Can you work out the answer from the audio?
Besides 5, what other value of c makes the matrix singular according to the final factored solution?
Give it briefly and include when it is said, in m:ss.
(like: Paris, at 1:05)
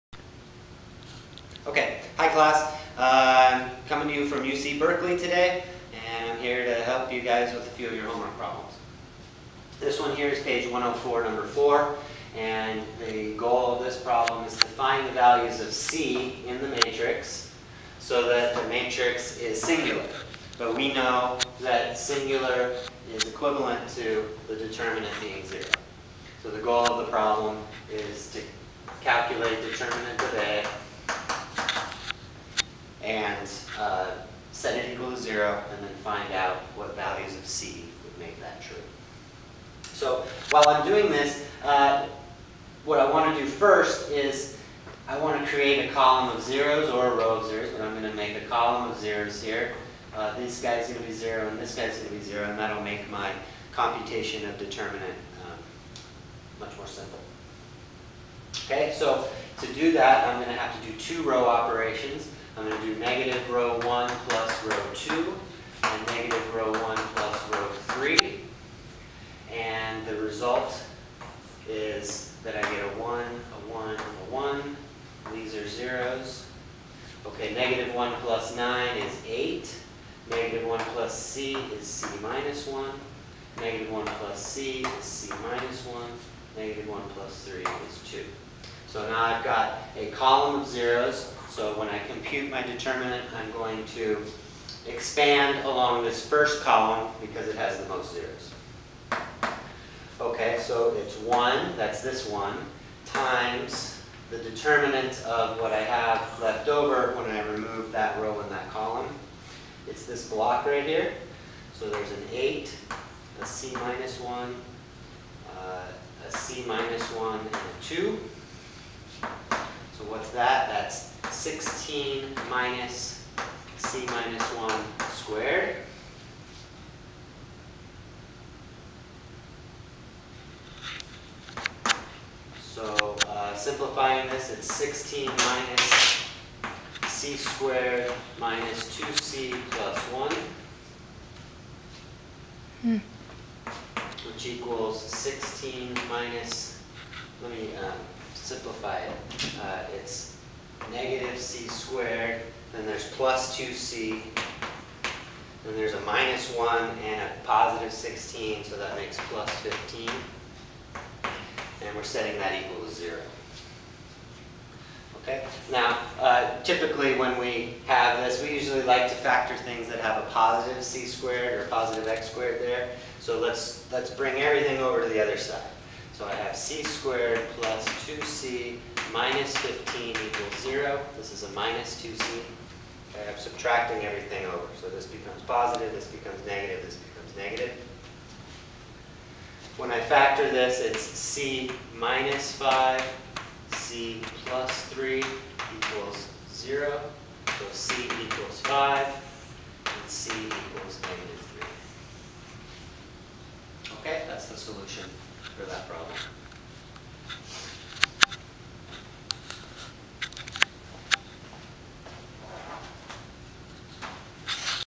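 -3, at 3:21.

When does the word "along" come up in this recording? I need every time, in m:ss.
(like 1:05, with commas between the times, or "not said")
1:35.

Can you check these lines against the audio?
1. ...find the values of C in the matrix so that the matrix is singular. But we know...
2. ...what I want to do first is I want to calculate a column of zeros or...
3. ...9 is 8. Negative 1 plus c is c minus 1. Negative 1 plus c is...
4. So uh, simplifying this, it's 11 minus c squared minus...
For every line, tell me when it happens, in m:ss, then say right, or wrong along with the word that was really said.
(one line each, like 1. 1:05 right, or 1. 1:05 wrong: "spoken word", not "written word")
1. 0:14 right
2. 0:42 wrong: "create", not "calculate"
3. 1:18 right
4. 2:12 wrong: "16", not "11".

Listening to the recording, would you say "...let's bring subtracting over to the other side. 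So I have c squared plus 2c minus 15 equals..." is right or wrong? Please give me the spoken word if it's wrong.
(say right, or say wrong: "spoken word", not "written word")
wrong: "everything", not "subtracting".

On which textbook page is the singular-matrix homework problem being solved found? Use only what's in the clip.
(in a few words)
104.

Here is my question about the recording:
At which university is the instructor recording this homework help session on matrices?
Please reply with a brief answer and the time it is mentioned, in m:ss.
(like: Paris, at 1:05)
UC Berkeley, at 0:04.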